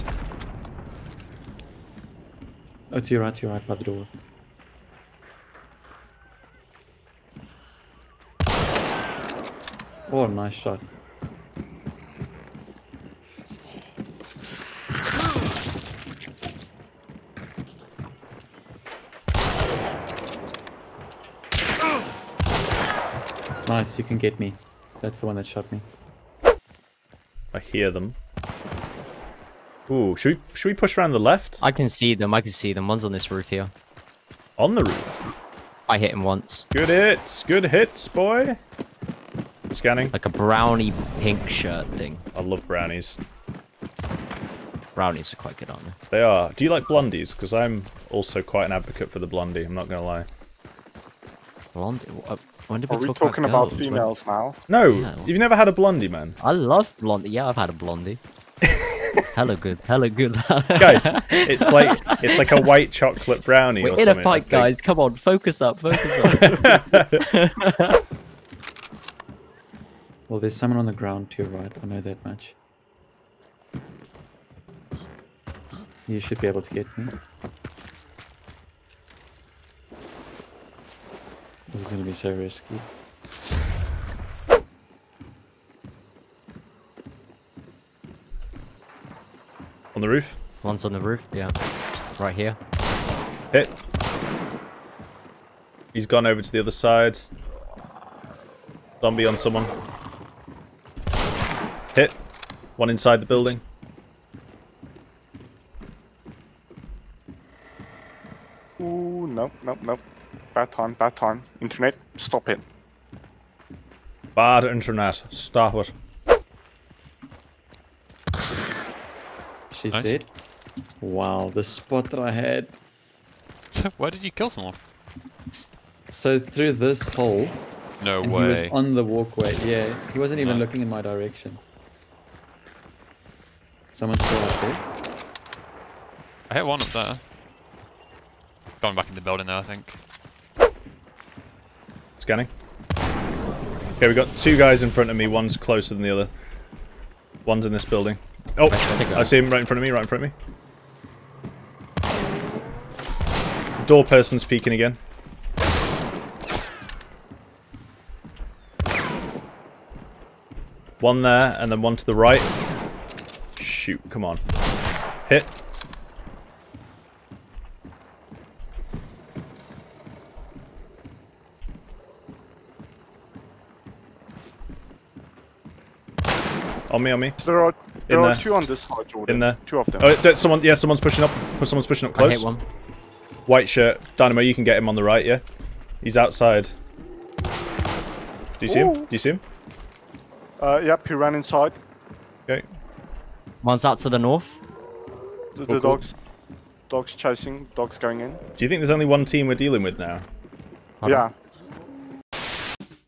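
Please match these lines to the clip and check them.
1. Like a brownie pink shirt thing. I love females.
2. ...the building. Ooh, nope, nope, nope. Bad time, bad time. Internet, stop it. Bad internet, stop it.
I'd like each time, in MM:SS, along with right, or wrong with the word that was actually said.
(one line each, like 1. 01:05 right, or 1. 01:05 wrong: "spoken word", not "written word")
1. 00:40 wrong: "brownies", not "females"
2. 01:43 right.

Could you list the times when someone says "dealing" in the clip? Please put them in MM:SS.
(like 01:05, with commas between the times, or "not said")
03:19.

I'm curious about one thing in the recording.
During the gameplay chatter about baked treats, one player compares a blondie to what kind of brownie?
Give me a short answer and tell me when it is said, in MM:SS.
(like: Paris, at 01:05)
White chocolate brownie, at 01:02.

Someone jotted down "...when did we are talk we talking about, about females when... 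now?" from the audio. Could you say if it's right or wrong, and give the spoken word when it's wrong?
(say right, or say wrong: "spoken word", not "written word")
right.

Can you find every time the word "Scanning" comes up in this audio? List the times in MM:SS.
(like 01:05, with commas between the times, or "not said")
00:39, 02:22.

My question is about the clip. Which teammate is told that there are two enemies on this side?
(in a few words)
Jordan.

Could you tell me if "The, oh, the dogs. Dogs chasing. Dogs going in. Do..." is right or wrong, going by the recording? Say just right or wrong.
right.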